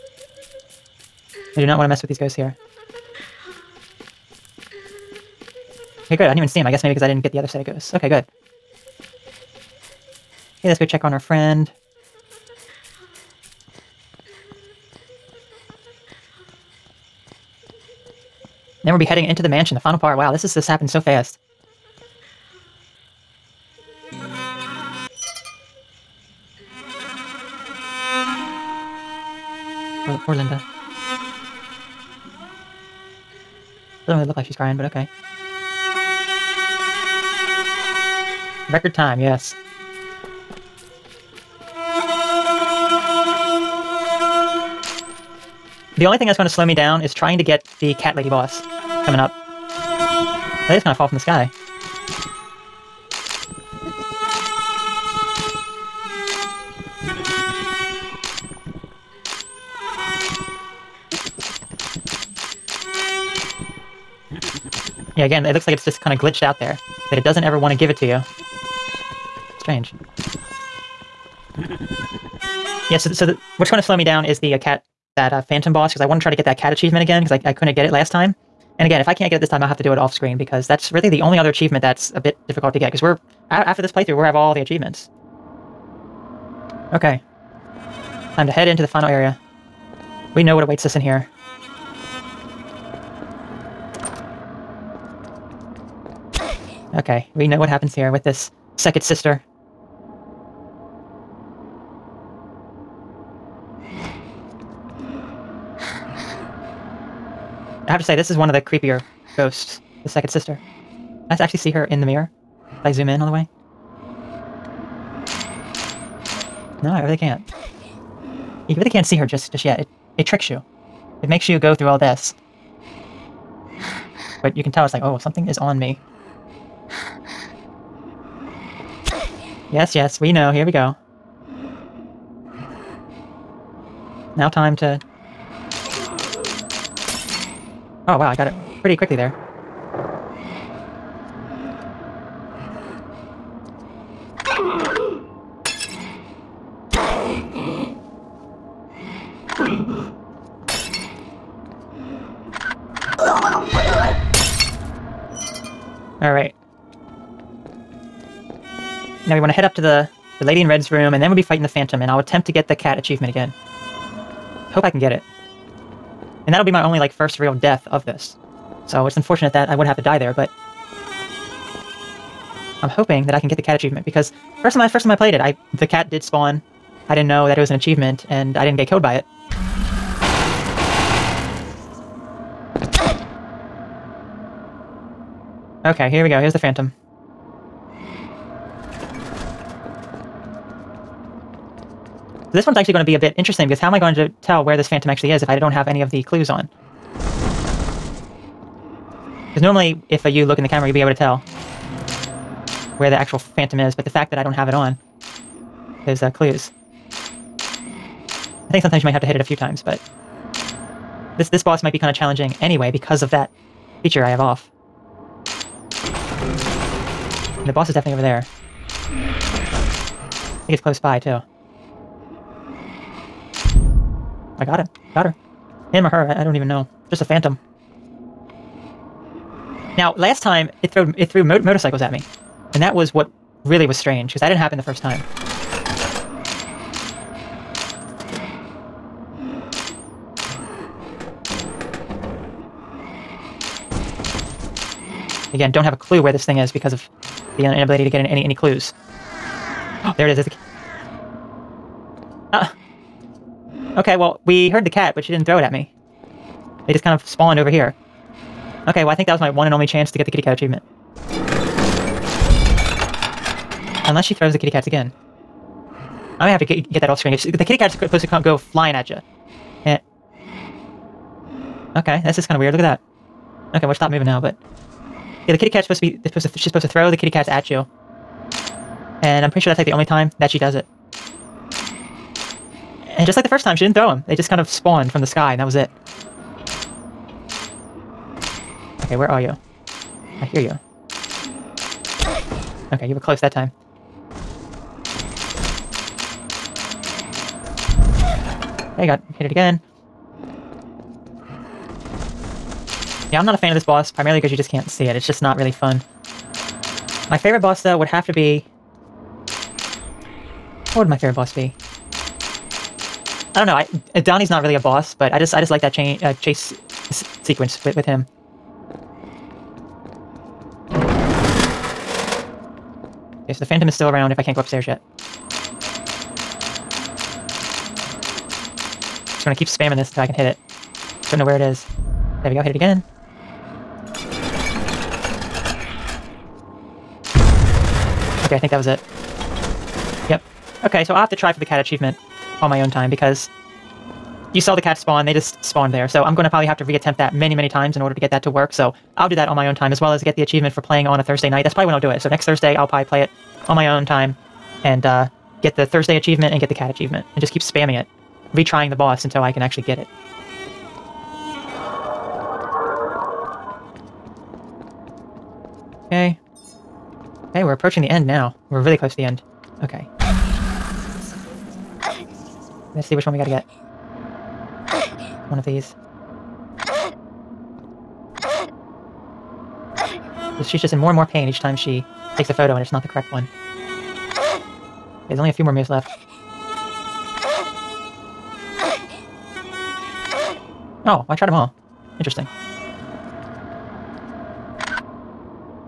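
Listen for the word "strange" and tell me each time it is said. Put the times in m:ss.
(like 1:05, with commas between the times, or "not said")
1:09, 3:53.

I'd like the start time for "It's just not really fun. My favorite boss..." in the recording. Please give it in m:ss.
5:05.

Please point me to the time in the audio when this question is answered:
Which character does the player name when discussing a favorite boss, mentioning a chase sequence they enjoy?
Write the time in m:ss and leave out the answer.
5:14.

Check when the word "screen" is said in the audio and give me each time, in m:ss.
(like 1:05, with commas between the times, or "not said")
1:20, 4:27.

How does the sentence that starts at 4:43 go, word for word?
And just like the first time, she didn't throw them.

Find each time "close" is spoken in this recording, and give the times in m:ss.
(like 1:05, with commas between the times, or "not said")
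3:40, 4:53, 6:08.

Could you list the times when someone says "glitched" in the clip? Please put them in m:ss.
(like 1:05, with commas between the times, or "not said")
1:06.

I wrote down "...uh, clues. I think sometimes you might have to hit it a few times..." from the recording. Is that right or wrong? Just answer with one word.
right.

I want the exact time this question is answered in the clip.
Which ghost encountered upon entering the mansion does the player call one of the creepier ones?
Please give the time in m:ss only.
1:50.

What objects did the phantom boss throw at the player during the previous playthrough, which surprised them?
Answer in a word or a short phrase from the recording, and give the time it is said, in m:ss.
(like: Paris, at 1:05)
Motorcycles, at 3:51.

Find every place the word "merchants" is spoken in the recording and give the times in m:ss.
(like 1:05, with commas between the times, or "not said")
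not said.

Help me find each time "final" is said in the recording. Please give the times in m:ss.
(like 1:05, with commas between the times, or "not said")
0:19, 1:28.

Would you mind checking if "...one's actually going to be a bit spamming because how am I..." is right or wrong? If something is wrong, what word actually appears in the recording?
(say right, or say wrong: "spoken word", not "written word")
wrong: "interesting", not "spamming".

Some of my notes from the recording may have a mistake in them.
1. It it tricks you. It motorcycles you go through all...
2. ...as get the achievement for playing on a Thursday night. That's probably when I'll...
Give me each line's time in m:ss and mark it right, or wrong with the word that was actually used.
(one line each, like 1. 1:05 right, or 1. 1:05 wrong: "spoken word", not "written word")
1. 1:59 wrong: "makes", not "motorcycles"
2. 5:50 right.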